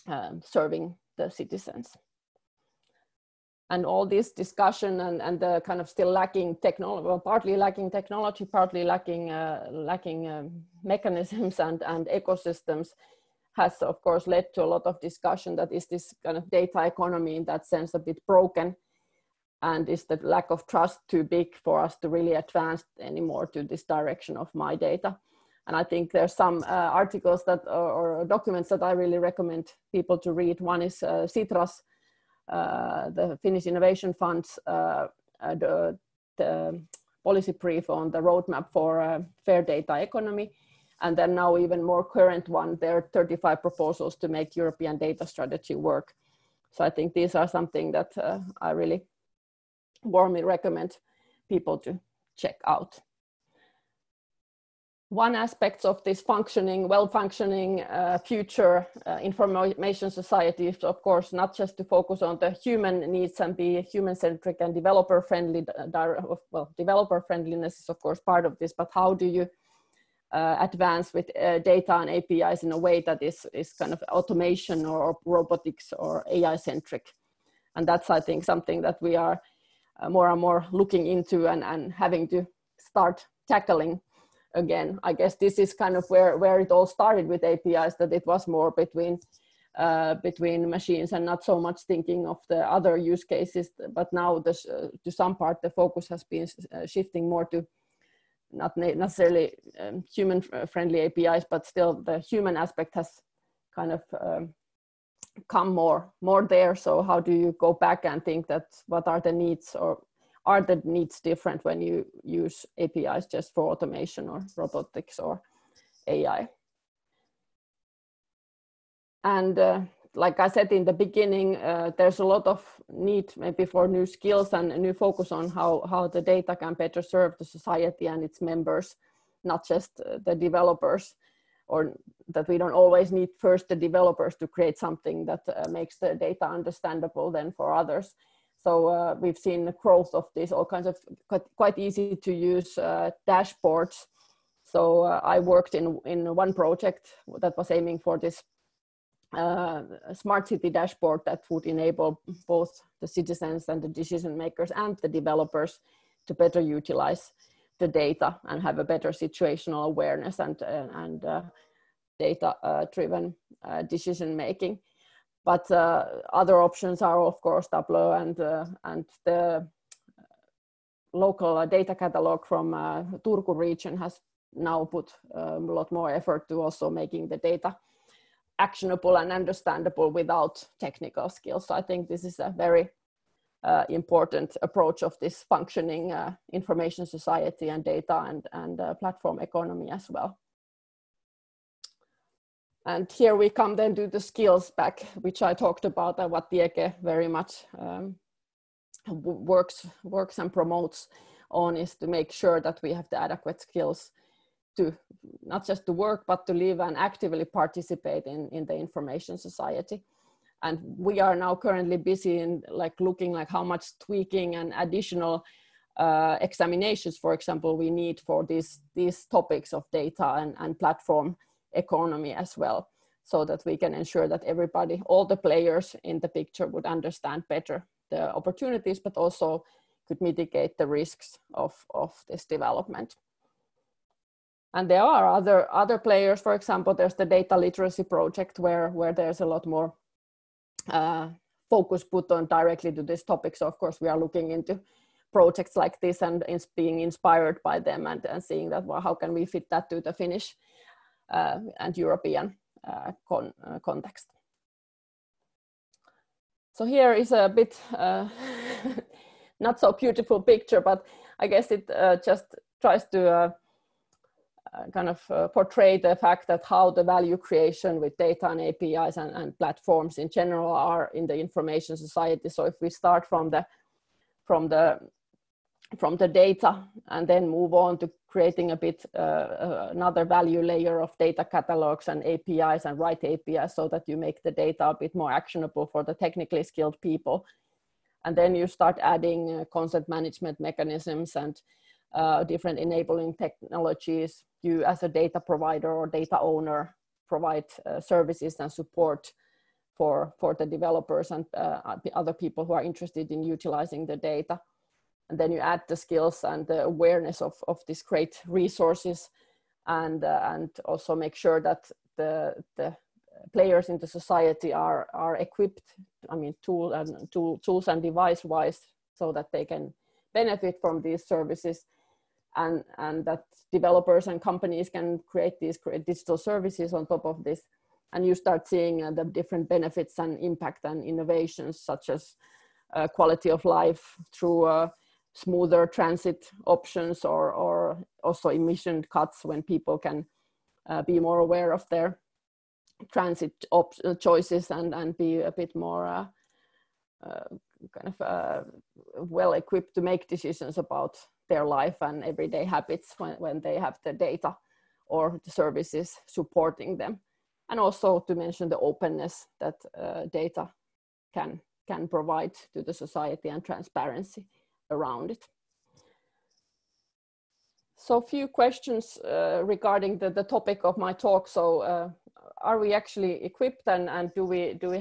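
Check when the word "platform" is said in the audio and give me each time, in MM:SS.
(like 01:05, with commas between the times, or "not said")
03:08, 03:40, 04:29.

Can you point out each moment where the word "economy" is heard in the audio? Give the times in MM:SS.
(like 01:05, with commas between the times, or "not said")
00:16, 00:39, 03:09, 03:41.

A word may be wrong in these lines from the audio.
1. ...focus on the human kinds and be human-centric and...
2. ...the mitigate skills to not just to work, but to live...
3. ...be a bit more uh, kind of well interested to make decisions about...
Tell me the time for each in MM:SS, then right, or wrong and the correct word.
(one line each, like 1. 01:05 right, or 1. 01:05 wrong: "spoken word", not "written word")
1. 01:01 wrong: "needs", not "kinds"
2. 03:23 wrong: "adequate", not "mitigate"
3. 05:45 wrong: "equipped", not "interested".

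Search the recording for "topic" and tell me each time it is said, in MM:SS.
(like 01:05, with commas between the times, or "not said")
03:39, 04:03, 06:10.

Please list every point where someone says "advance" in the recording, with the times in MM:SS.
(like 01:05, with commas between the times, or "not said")
00:22, 01:10.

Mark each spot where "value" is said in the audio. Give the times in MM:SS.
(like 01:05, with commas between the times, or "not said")
04:27, 04:40.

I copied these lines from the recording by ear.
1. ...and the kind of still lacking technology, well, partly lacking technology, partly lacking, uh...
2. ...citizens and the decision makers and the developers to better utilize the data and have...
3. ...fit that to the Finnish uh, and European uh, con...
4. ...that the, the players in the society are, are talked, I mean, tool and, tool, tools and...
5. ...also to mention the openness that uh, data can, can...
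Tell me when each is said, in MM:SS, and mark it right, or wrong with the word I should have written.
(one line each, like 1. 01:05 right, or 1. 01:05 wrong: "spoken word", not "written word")
1. 00:05 right
2. 02:33 right
3. 04:09 right
4. 05:11 wrong: "equipped", not "talked"
5. 05:57 right.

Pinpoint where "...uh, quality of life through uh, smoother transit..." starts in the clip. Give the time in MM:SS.
05:32.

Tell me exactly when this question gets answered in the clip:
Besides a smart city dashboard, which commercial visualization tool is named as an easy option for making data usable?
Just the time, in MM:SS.
02:47.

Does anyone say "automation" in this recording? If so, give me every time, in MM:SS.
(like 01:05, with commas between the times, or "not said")
01:14, 01:53.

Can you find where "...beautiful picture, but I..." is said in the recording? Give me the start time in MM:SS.
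04:19.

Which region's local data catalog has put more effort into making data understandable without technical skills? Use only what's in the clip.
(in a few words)
Turku.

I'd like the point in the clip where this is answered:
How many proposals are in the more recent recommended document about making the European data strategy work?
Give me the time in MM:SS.
00:43.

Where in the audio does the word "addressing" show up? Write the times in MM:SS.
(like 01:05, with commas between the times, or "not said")
not said.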